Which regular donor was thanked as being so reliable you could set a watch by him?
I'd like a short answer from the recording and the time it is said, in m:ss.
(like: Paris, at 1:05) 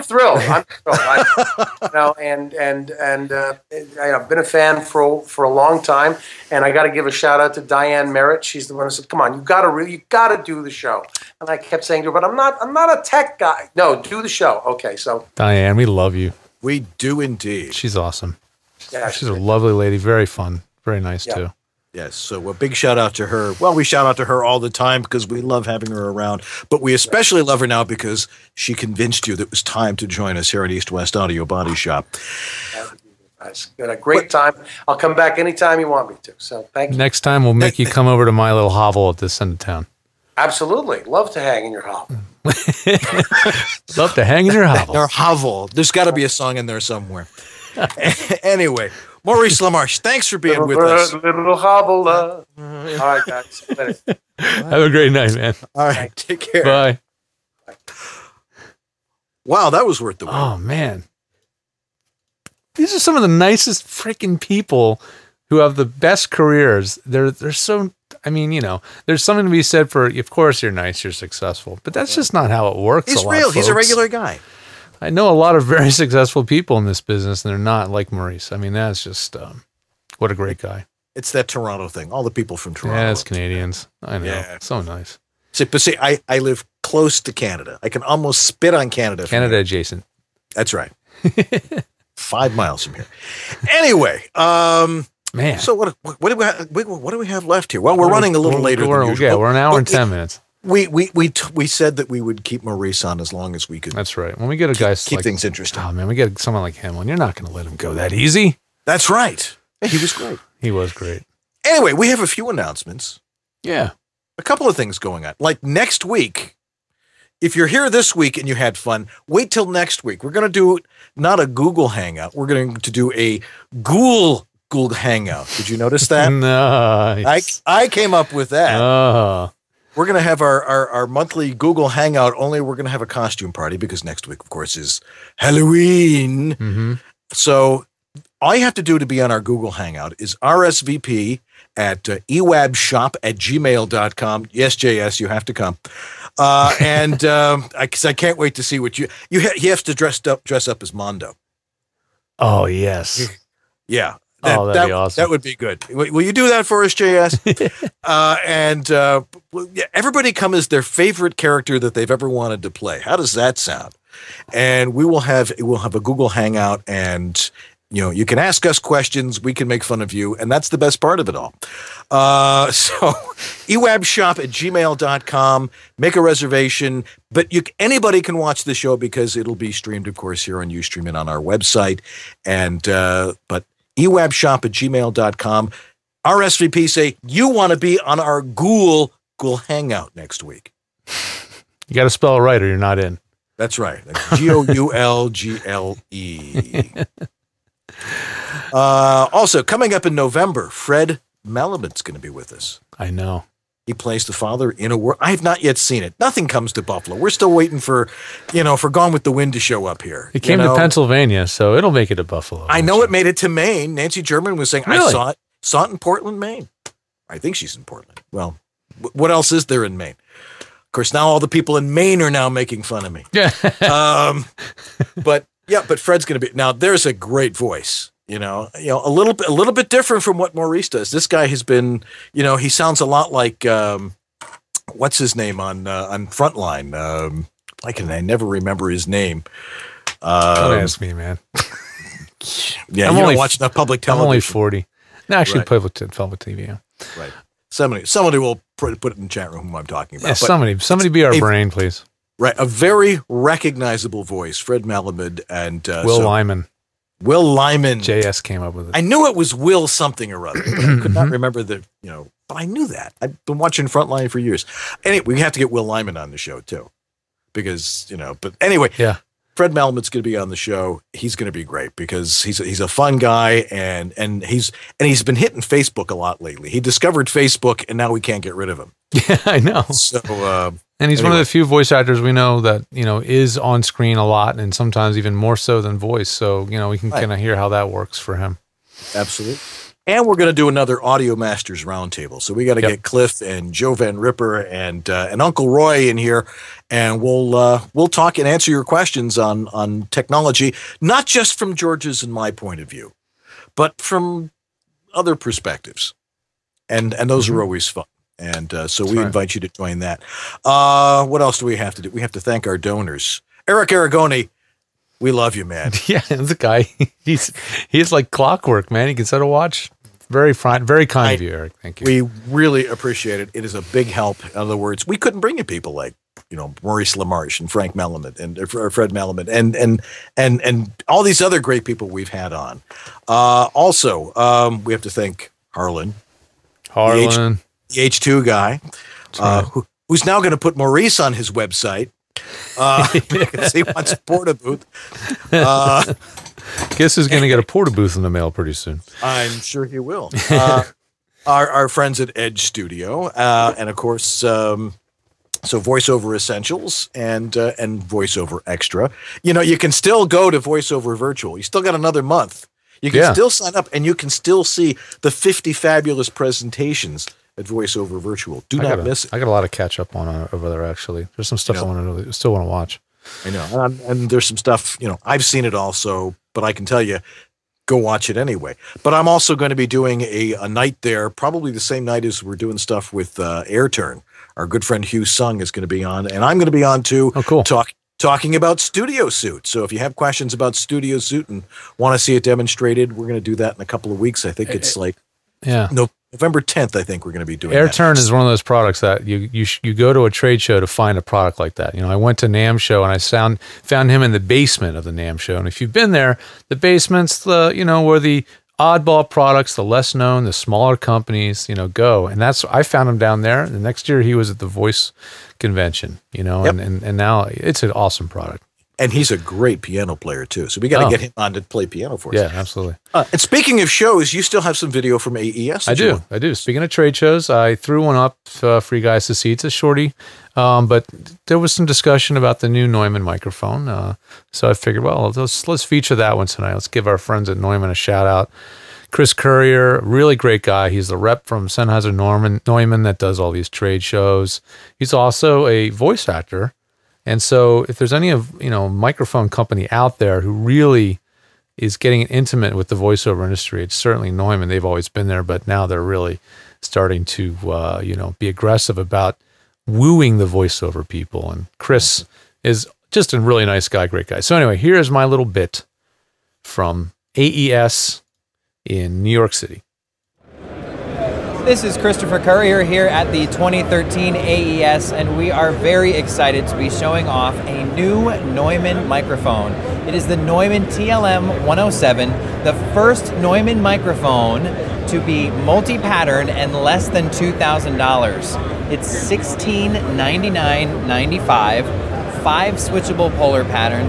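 Eric Aragoni, at 5:13.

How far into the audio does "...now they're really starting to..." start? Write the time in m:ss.
7:35.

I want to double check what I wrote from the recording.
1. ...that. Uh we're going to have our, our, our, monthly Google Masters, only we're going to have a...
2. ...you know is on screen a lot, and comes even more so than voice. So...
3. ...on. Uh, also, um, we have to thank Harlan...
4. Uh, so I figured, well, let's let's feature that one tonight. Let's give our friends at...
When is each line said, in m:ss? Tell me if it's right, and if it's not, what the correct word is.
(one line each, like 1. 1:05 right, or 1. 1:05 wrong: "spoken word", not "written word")
1. 2:08 wrong: "Hangout", not "Masters"
2. 4:42 wrong: "sometimes", not "comes"
3. 5:32 right
4. 7:13 right.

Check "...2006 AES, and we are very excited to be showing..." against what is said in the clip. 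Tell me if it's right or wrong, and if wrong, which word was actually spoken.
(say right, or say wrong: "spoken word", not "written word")
wrong: "2013", not "2006".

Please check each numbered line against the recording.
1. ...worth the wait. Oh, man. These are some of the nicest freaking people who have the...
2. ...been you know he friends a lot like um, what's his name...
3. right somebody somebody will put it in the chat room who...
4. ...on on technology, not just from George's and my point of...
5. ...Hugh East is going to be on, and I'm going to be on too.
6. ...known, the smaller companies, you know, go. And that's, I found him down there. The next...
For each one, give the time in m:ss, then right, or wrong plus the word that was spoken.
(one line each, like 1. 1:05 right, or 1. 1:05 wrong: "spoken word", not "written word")
1. 0:59 right
2. 3:51 wrong: "sounds", not "friends"
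3. 4:07 right
4. 4:59 right
5. 6:25 wrong: "Sung", not "East"
6. 6:50 right.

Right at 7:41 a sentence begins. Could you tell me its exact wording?
And Chris is just a really nice guy, great guy.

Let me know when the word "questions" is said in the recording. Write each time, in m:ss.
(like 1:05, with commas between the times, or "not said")
2:48, 4:58, 6:30.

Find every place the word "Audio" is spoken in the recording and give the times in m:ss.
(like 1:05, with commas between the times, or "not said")
0:31, 4:51.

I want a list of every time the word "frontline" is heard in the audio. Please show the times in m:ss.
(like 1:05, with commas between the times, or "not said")
3:56, 4:23.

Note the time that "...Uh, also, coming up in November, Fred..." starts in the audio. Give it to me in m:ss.
3:18.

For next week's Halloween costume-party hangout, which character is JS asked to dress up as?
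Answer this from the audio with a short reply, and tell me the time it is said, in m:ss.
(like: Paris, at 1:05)
Mondo, at 2:30.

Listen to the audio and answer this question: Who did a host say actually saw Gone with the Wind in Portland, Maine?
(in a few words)
Nancy German.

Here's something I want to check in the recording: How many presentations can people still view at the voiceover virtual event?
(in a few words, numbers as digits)
50.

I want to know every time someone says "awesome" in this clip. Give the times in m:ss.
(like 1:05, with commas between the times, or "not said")
0:17, 2:34, 6:57.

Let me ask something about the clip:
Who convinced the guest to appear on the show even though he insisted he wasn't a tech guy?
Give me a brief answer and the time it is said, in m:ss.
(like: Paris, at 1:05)
Diane Merritt, at 0:07.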